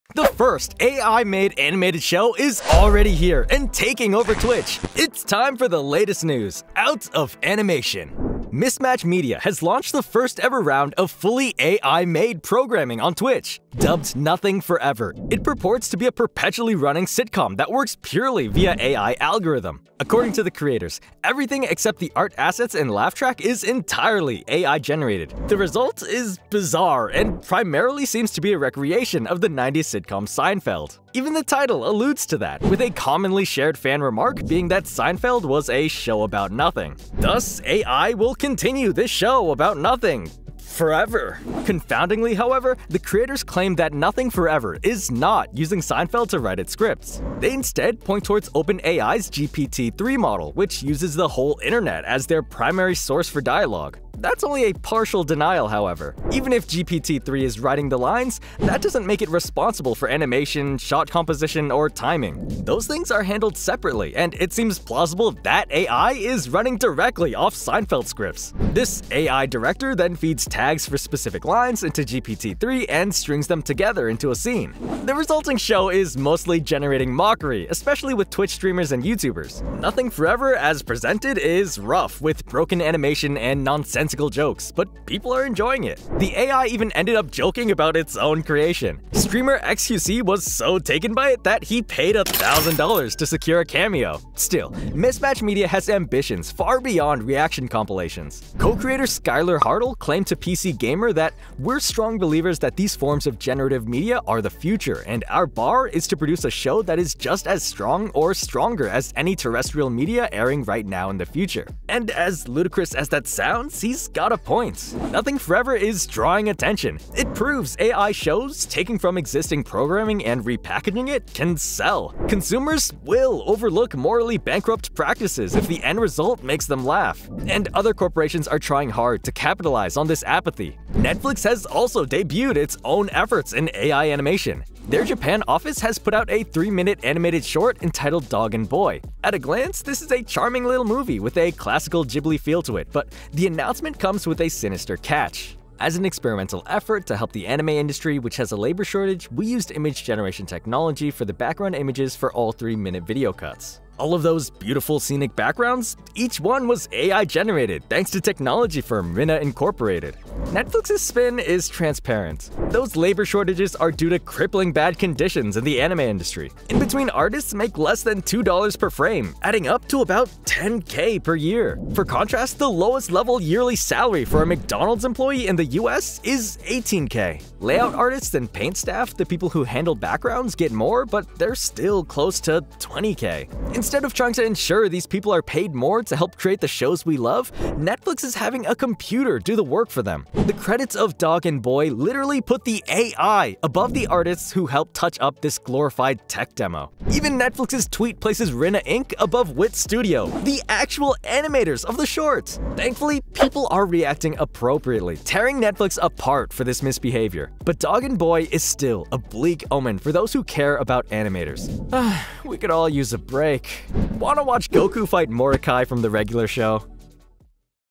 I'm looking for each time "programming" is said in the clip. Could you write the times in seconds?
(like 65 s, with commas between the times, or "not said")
12 s, 119 s.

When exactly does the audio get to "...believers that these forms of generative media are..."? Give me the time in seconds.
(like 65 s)
102 s.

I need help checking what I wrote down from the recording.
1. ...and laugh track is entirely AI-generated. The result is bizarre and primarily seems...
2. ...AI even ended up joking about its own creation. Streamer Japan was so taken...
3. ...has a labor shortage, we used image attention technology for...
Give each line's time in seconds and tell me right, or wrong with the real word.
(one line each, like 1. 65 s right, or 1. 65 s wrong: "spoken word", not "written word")
1. 22 s right
2. 86 s wrong: "XQC", not "Japan"
3. 148 s wrong: "generation", not "attention".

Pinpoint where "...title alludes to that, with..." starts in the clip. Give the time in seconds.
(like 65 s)
31 s.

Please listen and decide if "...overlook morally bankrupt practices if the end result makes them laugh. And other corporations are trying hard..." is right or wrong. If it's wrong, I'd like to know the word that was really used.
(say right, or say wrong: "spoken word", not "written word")
right.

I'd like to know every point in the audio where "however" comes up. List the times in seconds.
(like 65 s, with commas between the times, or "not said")
42 s, 55 s.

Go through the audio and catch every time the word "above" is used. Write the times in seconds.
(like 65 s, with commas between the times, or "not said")
193 s, 199 s.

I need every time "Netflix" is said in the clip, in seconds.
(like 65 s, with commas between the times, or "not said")
130 s, 160 s, 187 s, 197 s, 205 s.